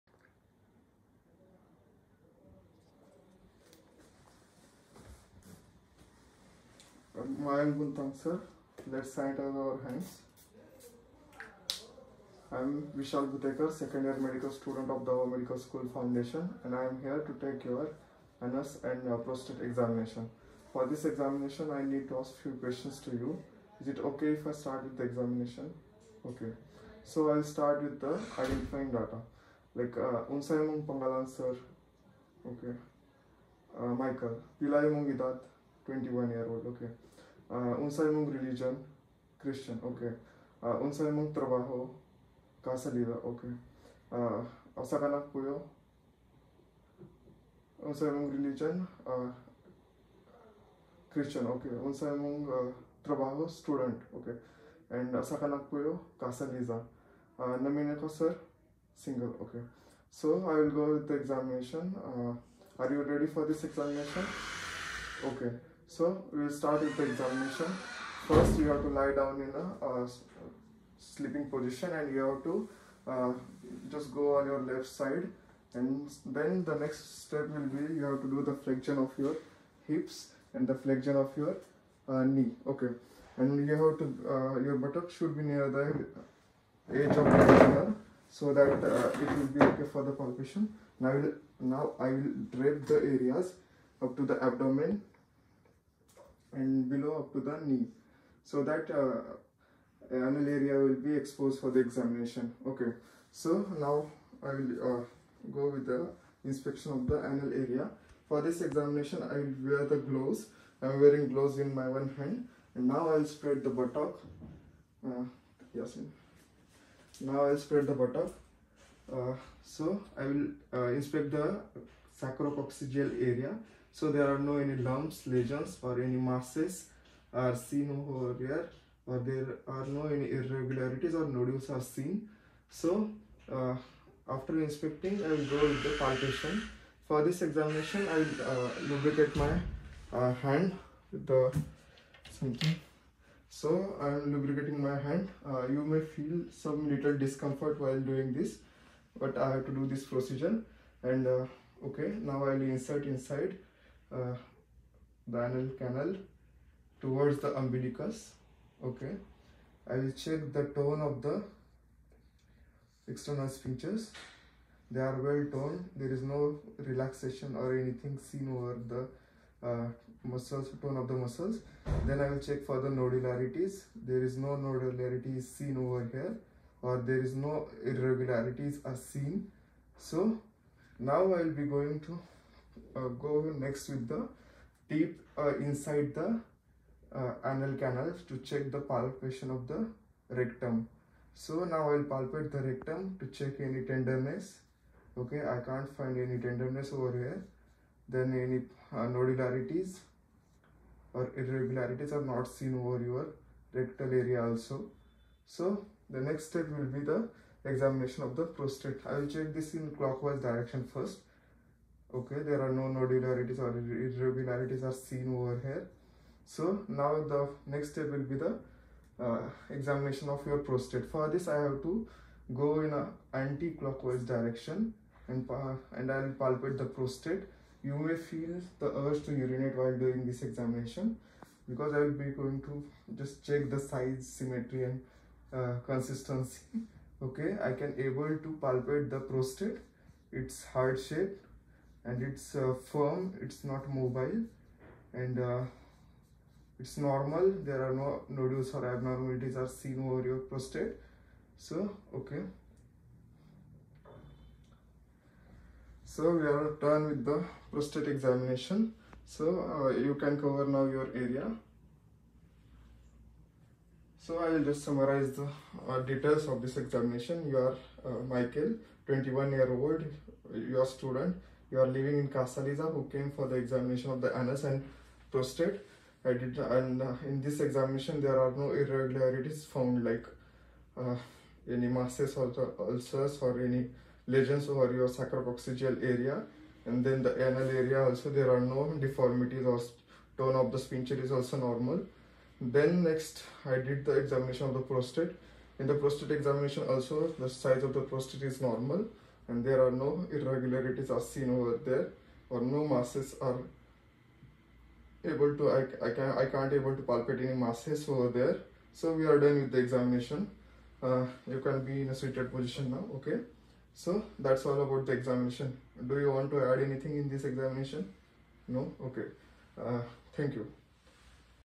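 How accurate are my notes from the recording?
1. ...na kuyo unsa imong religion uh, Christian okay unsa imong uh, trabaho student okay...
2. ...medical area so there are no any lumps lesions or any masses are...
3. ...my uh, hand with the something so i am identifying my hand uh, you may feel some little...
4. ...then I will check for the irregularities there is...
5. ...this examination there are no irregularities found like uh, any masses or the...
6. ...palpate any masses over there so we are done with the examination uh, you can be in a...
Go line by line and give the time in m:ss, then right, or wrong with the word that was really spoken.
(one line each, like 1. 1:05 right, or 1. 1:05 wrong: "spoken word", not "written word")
1. 0:45 right
2. 2:02 wrong: "sacrococcygeal", not "medical"
3. 2:19 wrong: "lubricating", not "identifying"
4. 2:52 wrong: "nodularities", not "irregularities"
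5. 4:37 right
6. 5:07 right.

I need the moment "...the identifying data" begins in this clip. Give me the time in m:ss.
0:28.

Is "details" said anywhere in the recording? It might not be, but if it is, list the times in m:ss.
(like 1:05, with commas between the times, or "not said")
4:26.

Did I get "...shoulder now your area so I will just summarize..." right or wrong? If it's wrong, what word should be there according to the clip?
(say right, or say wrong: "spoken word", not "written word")
wrong: "cover", not "shoulder".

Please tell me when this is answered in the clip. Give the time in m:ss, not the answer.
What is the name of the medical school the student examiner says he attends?
0:15.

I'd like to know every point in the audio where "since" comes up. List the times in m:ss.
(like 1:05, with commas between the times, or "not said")
not said.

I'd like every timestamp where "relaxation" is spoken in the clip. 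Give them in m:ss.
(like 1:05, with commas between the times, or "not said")
2:46.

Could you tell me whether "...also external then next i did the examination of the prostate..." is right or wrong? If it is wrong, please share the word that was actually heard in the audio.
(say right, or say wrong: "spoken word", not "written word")
wrong: "normal", not "external".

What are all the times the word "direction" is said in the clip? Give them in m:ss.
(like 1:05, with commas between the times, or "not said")
3:30, 3:44.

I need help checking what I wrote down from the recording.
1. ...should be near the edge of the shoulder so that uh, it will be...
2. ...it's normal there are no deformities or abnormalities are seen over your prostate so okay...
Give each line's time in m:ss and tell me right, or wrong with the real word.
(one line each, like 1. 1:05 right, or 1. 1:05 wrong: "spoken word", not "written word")
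1. 1:25 right
2. 4:06 wrong: "nodules", not "deformities".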